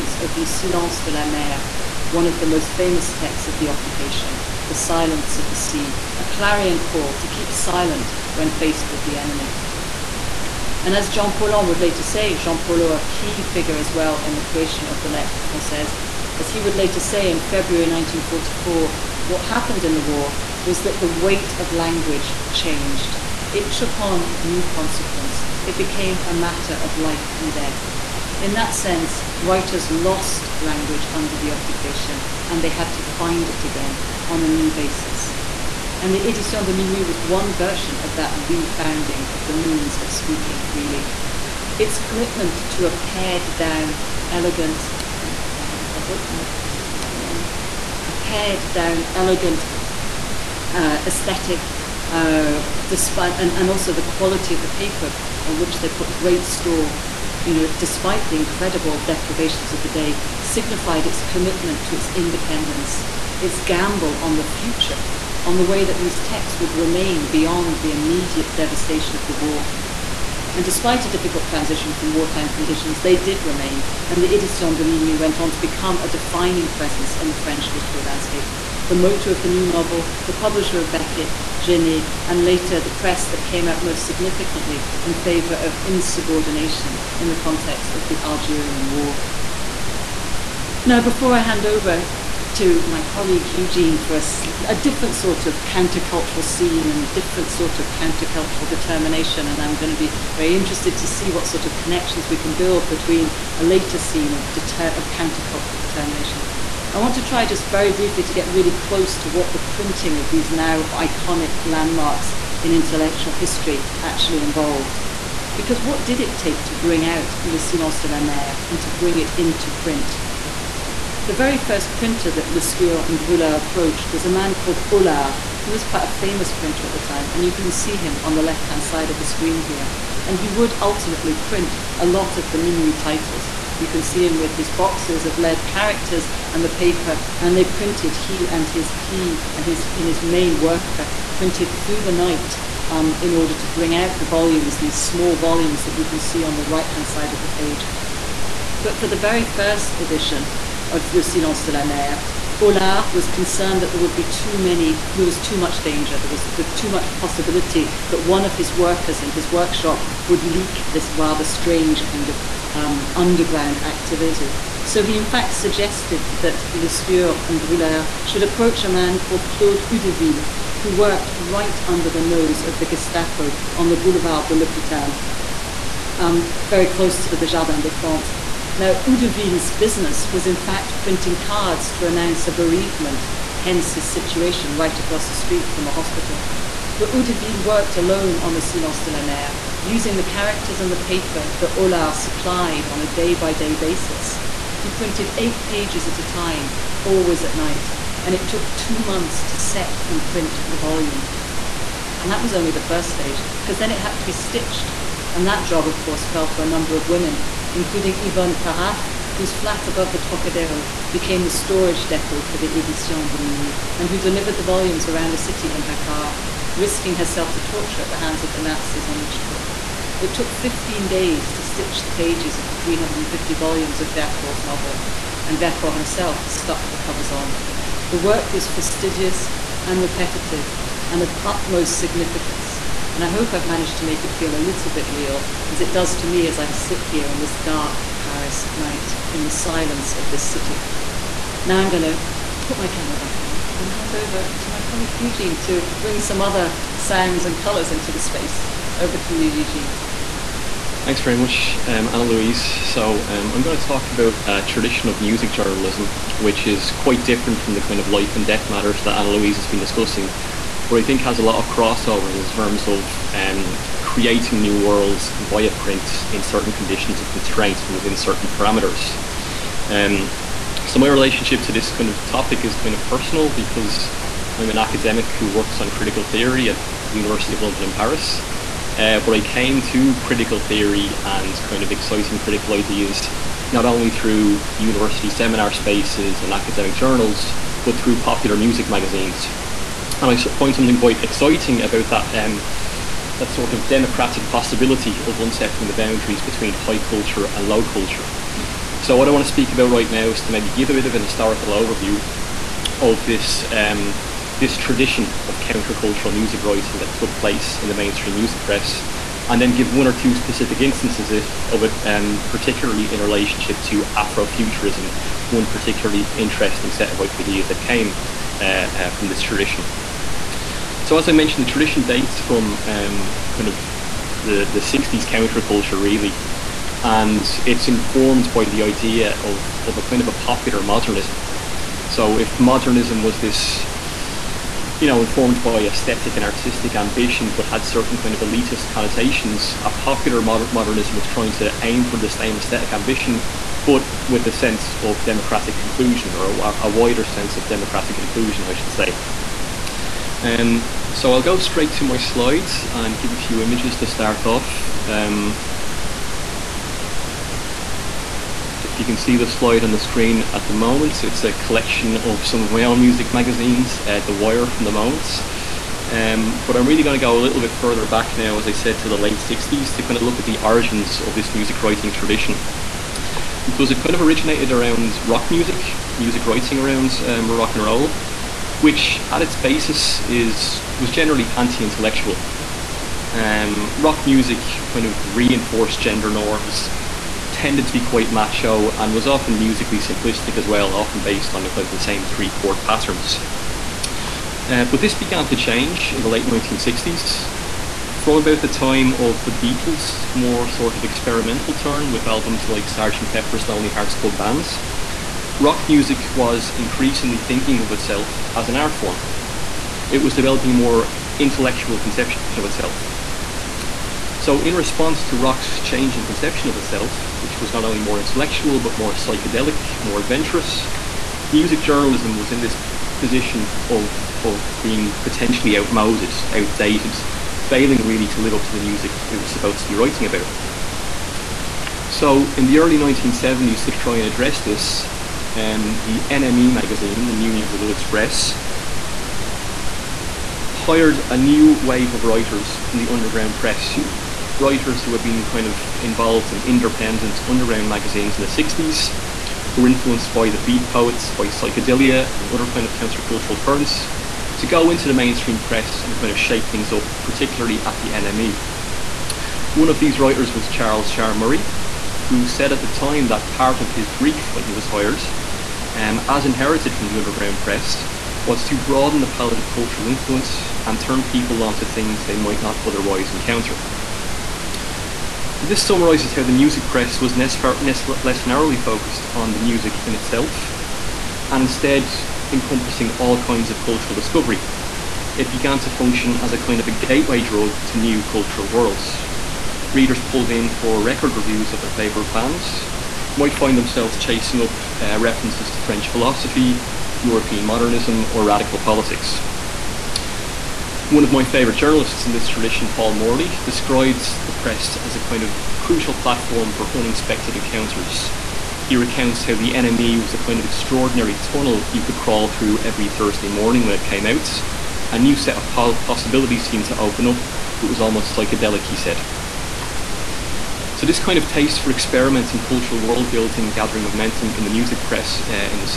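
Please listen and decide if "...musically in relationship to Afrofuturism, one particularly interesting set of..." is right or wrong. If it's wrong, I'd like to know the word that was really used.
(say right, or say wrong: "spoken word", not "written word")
wrong: "particularly", not "musically".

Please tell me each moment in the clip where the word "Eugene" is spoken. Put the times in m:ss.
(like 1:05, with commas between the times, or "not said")
1:33, 4:05, 4:09.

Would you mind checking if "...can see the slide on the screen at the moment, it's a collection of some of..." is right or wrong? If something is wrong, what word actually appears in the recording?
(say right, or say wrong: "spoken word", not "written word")
right.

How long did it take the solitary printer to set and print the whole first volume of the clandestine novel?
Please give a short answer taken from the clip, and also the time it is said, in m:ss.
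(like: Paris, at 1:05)
Two months, at 3:18.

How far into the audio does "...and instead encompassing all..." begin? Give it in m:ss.
8:01.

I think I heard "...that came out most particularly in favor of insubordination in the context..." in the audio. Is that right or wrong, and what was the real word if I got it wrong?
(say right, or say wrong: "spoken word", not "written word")
wrong: "significantly", not "particularly".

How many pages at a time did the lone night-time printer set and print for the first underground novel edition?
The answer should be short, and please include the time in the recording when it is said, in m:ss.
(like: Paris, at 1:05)
8, at 3:15.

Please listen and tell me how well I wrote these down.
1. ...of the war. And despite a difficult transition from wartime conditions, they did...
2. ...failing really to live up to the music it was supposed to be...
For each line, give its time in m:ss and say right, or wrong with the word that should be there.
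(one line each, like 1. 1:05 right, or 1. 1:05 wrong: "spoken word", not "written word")
1. 1:09 right
2. 7:07 right.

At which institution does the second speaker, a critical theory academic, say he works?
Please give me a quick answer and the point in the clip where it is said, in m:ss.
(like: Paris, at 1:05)
University of London, at 4:37.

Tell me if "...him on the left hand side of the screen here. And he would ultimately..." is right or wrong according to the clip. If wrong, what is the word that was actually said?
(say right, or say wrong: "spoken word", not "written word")
right.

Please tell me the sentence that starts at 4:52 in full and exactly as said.
Um, that sort of democratic possibility of unsettling the boundaries between high culture and low culture.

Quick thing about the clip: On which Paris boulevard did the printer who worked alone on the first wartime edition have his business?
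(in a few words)
Boulevard de l'Hôpital.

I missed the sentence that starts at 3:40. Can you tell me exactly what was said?
It took 15 days to stitch the pages of the 350 volumes of Vercors' novel, and Vercors himself stuck the covers on.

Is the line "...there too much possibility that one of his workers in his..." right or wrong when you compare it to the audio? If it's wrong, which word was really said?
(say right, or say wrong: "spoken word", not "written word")
right.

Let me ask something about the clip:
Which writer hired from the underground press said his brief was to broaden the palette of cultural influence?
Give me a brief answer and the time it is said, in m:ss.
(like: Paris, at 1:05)
Charles Shaar Murray, at 7:40.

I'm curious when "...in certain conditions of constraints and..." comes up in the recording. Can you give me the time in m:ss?
4:26.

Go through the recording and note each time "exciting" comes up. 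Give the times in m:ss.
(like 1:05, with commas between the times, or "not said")
4:41, 4:51.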